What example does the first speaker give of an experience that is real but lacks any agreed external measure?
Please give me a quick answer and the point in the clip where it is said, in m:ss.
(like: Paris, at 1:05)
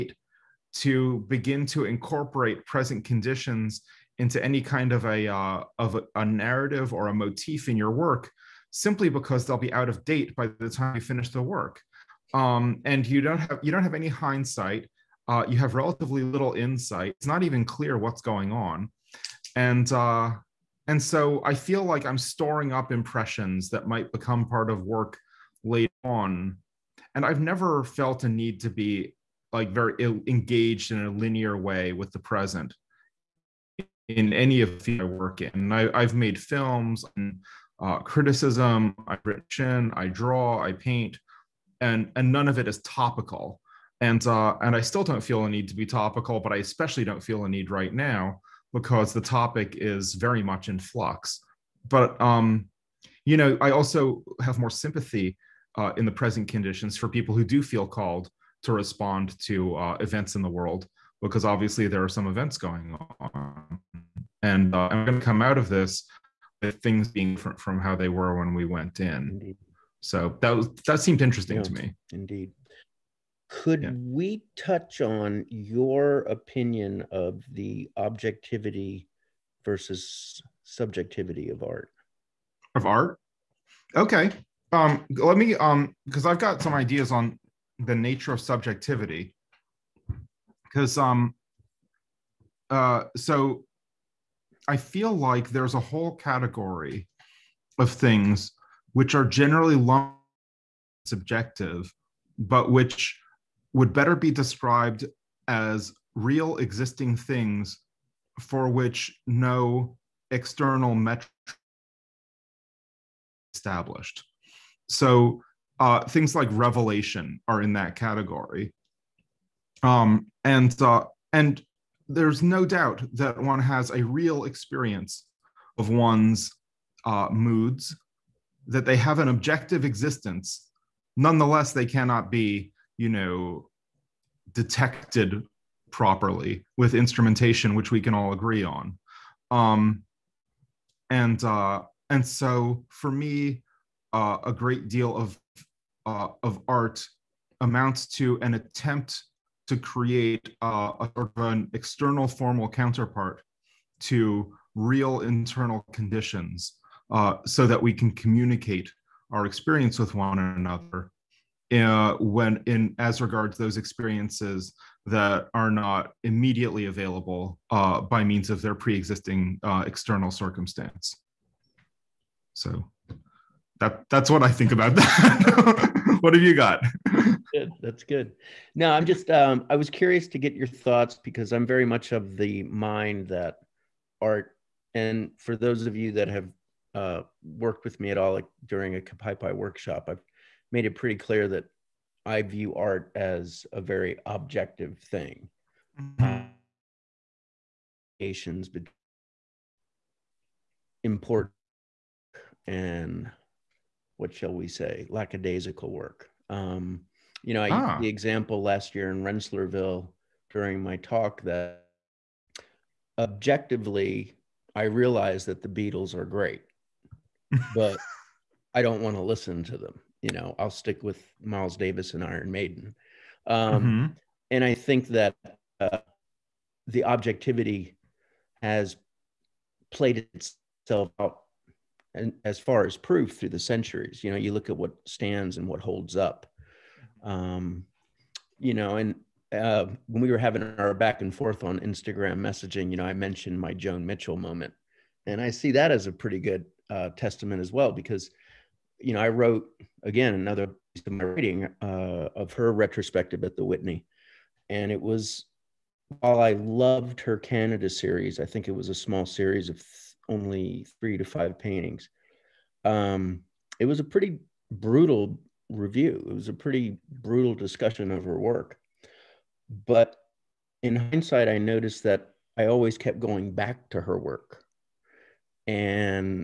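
Revelation, at 1:56.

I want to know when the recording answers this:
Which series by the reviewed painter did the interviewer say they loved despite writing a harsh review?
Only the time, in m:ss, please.
4:17.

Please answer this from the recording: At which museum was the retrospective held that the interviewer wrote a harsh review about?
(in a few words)
Whitney.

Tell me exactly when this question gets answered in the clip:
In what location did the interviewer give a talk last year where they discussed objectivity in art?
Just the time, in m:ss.
3:29.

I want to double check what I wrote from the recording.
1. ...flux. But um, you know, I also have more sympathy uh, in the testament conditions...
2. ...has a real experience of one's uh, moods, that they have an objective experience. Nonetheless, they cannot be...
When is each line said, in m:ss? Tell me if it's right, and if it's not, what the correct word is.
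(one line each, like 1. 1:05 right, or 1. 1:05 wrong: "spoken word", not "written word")
1. 0:50 wrong: "present", not "testament"
2. 2:03 wrong: "existence", not "experience".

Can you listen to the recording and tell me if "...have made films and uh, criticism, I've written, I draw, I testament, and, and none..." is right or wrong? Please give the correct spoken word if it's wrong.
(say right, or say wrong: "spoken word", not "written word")
wrong: "paint", not "testament".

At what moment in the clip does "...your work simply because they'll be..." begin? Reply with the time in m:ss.
0:07.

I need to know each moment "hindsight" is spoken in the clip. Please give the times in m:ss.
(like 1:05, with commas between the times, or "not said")
0:14, 4:30.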